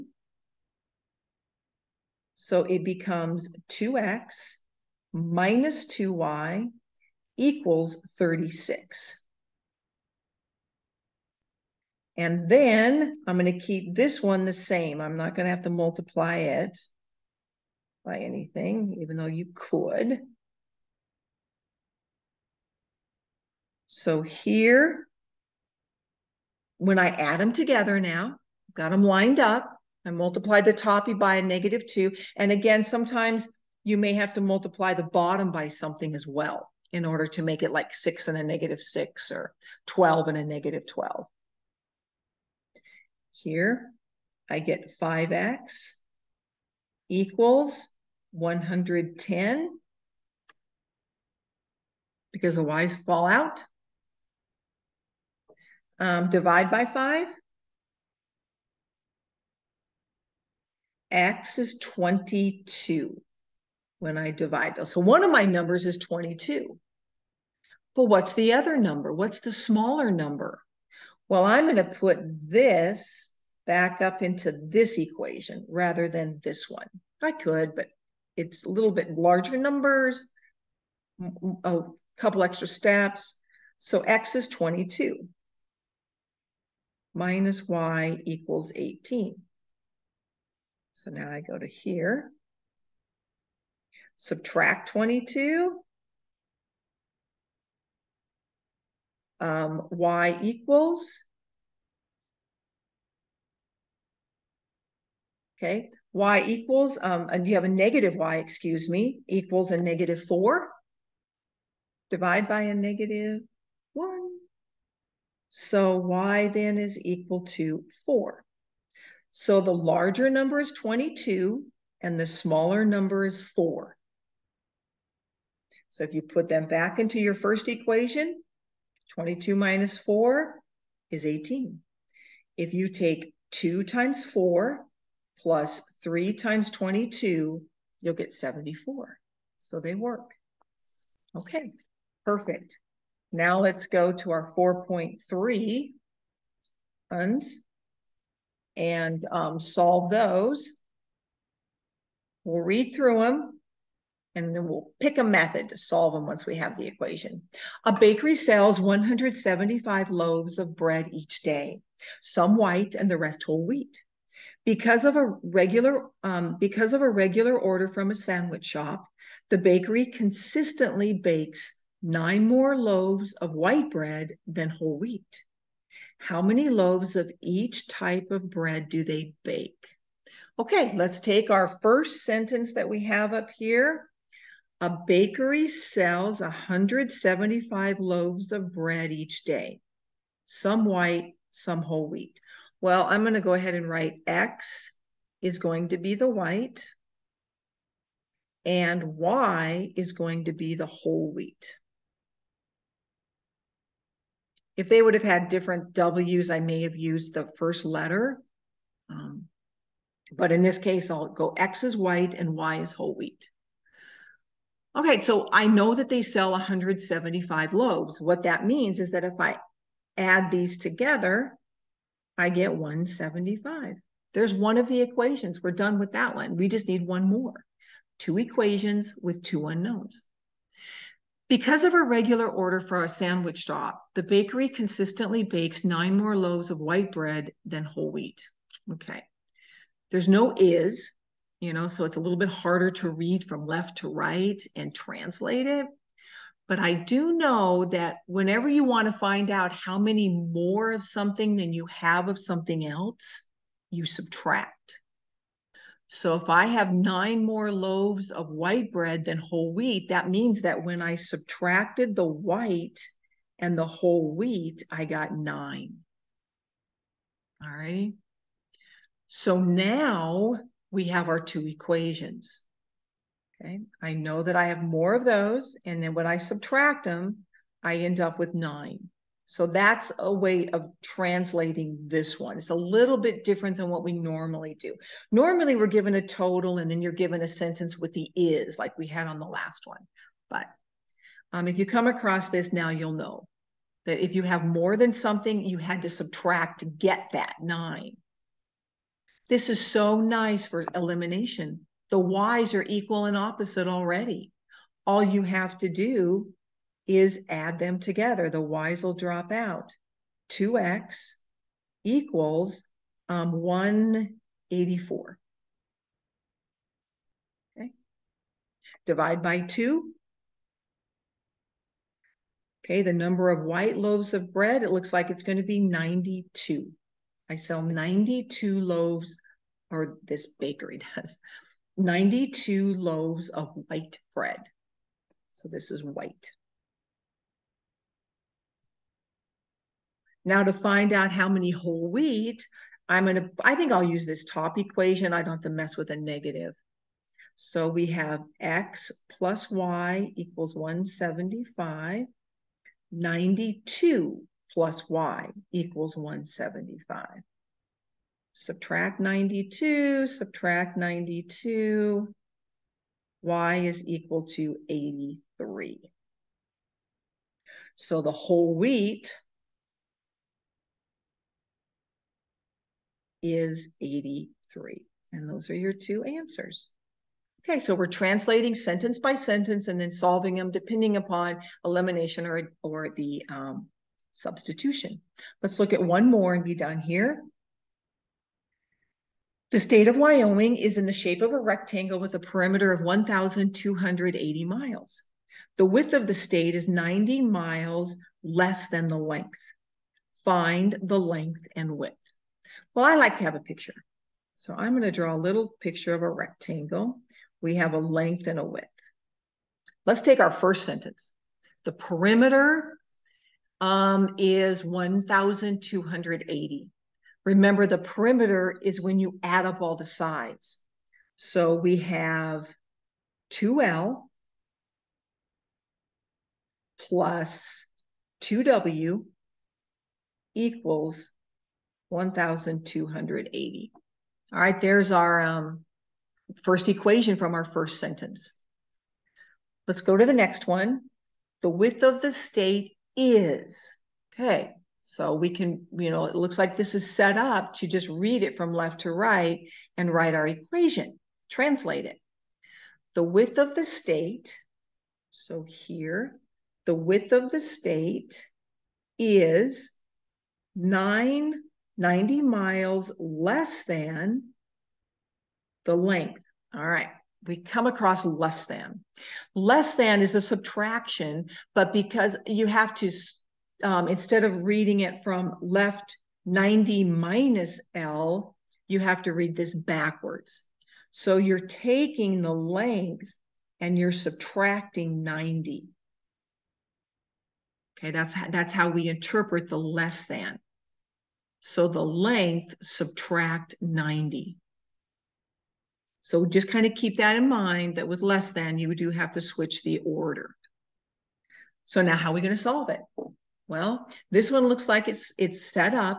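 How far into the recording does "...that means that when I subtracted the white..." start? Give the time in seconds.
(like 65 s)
260 s.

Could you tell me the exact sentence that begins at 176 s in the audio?
How many loaves of each type of bread do they bake?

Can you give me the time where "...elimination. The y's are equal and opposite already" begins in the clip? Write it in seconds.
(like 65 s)
300 s.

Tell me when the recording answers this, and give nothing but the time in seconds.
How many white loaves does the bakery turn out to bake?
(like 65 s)
331 s.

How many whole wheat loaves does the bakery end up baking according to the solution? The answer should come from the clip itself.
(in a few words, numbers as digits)
83.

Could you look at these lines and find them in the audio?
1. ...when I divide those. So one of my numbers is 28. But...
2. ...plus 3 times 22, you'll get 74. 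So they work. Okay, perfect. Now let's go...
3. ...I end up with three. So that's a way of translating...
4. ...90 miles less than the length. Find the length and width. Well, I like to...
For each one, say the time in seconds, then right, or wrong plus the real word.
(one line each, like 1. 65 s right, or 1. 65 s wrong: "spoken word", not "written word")
1. 63 s wrong: "22", not "28"
2. 135 s right
3. 277 s wrong: "nine", not "three"
4. 396 s right.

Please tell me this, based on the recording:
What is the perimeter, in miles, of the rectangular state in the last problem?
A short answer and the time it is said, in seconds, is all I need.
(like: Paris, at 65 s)
1,280 miles, at 393 s.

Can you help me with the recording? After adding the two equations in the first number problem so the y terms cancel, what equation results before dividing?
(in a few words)
5x = 110.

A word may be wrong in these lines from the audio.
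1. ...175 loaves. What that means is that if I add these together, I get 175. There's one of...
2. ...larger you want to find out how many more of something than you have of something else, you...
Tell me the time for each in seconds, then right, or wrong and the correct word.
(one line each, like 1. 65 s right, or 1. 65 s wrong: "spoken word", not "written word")
1. 216 s right
2. 248 s wrong: "whenever", not "larger".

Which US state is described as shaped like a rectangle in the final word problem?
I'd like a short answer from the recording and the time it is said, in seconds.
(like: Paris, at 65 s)
Wyoming, at 390 s.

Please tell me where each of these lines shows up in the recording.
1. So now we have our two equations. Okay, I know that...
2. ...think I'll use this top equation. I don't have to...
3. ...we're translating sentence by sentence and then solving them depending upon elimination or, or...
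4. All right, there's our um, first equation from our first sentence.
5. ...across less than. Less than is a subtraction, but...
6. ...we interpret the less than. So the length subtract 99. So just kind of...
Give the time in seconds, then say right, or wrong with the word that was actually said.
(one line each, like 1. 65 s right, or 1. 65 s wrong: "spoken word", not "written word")
1. 269 s right
2. 343 s right
3. 377 s right
4. 434 s right
5. 467 s right
6. 488 s wrong: "90", not "99".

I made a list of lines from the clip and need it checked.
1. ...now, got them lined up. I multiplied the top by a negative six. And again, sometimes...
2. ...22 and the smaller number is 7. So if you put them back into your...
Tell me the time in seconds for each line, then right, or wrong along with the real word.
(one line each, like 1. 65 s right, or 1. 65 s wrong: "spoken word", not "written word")
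1. 28 s wrong: "two", not "six"
2. 120 s wrong: "4", not "7".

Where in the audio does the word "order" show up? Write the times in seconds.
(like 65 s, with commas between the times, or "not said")
37 s, 167 s, 232 s, 500 s.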